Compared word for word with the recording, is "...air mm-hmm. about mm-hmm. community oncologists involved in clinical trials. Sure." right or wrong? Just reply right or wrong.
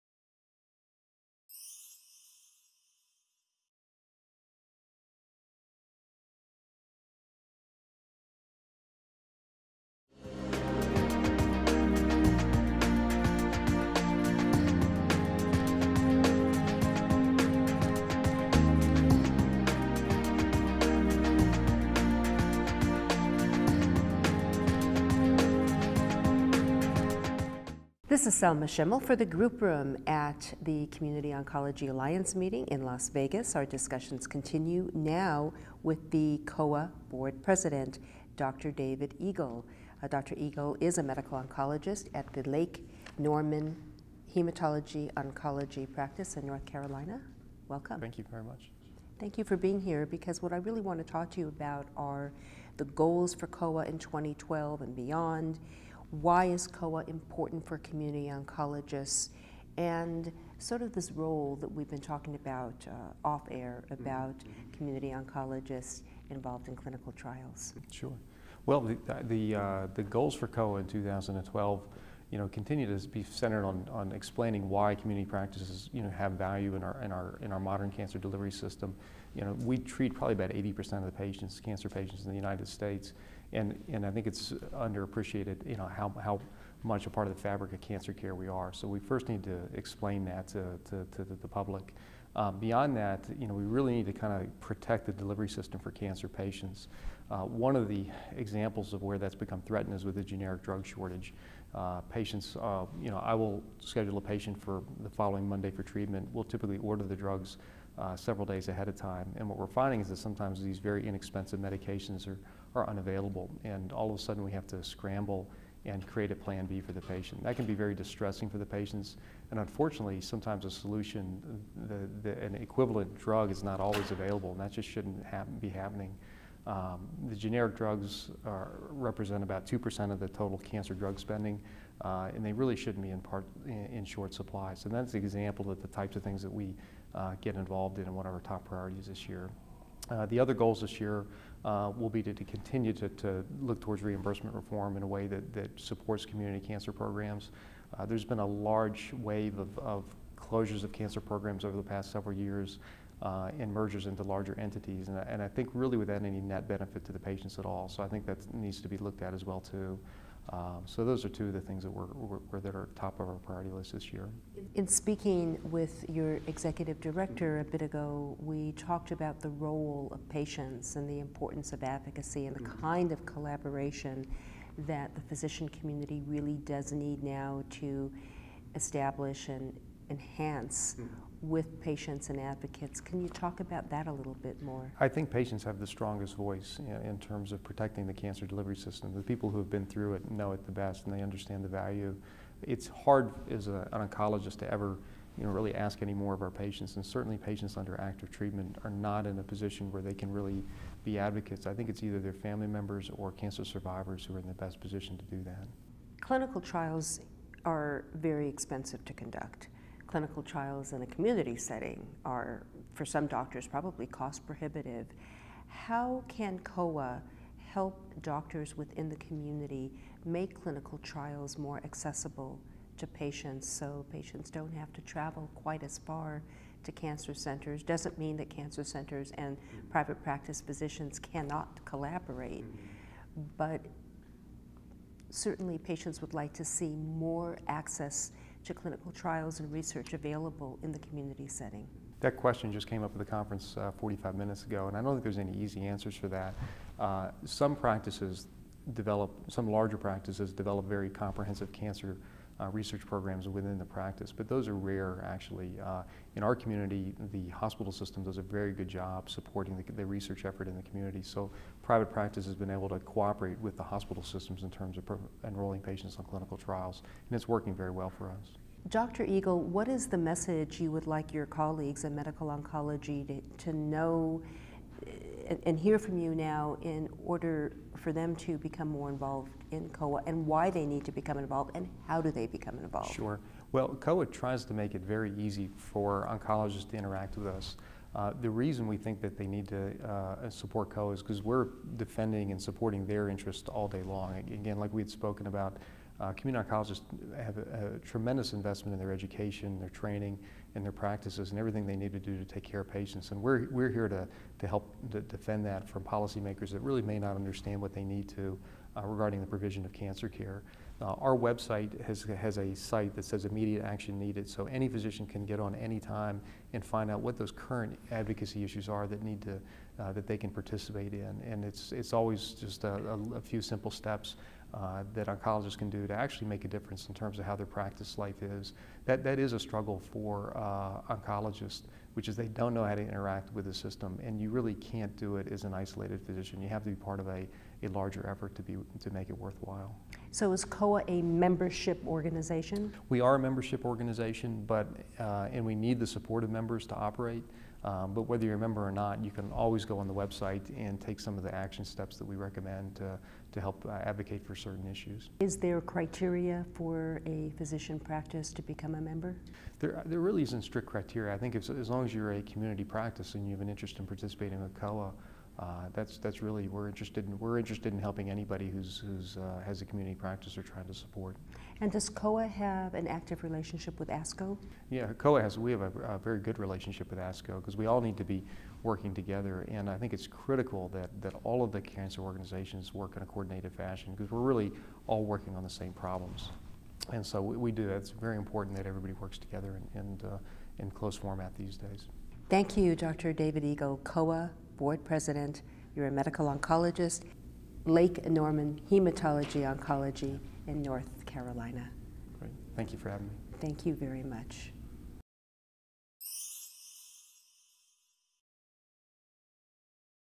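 right.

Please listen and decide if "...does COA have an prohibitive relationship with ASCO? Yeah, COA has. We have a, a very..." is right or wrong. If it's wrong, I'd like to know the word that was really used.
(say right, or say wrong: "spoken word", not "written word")
wrong: "active", not "prohibitive".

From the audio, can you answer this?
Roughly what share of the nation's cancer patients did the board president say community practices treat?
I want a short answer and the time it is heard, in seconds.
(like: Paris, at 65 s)
80%, at 80 s.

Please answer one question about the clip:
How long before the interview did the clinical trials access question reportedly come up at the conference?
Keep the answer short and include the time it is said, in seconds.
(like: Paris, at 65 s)
45 minutes, at 243 s.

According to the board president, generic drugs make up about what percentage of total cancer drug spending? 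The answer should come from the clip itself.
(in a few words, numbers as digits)
2%.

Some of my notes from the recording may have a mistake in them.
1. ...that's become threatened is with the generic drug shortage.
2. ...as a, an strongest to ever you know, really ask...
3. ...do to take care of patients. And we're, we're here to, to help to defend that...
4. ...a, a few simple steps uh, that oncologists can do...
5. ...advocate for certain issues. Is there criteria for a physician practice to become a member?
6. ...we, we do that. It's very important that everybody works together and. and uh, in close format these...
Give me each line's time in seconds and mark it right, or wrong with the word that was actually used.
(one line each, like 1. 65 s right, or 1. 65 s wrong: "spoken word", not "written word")
1. 99 s right
2. 193 s wrong: "oncologist", not "strongest"
3. 302 s right
4. 323 s right
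5. 354 s right
6. 387 s right.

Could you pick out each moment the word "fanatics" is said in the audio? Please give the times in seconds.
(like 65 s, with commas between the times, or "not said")
not said.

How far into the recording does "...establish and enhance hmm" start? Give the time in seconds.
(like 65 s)
178 s.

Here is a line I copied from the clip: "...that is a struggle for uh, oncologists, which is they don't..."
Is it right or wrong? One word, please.
right.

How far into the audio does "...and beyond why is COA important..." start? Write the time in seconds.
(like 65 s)
54 s.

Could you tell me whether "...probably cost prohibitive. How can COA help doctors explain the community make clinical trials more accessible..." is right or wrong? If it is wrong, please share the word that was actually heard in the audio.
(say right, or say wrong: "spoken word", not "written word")
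wrong: "within", not "explain".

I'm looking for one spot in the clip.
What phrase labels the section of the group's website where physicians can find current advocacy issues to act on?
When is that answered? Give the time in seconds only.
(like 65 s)
313 s.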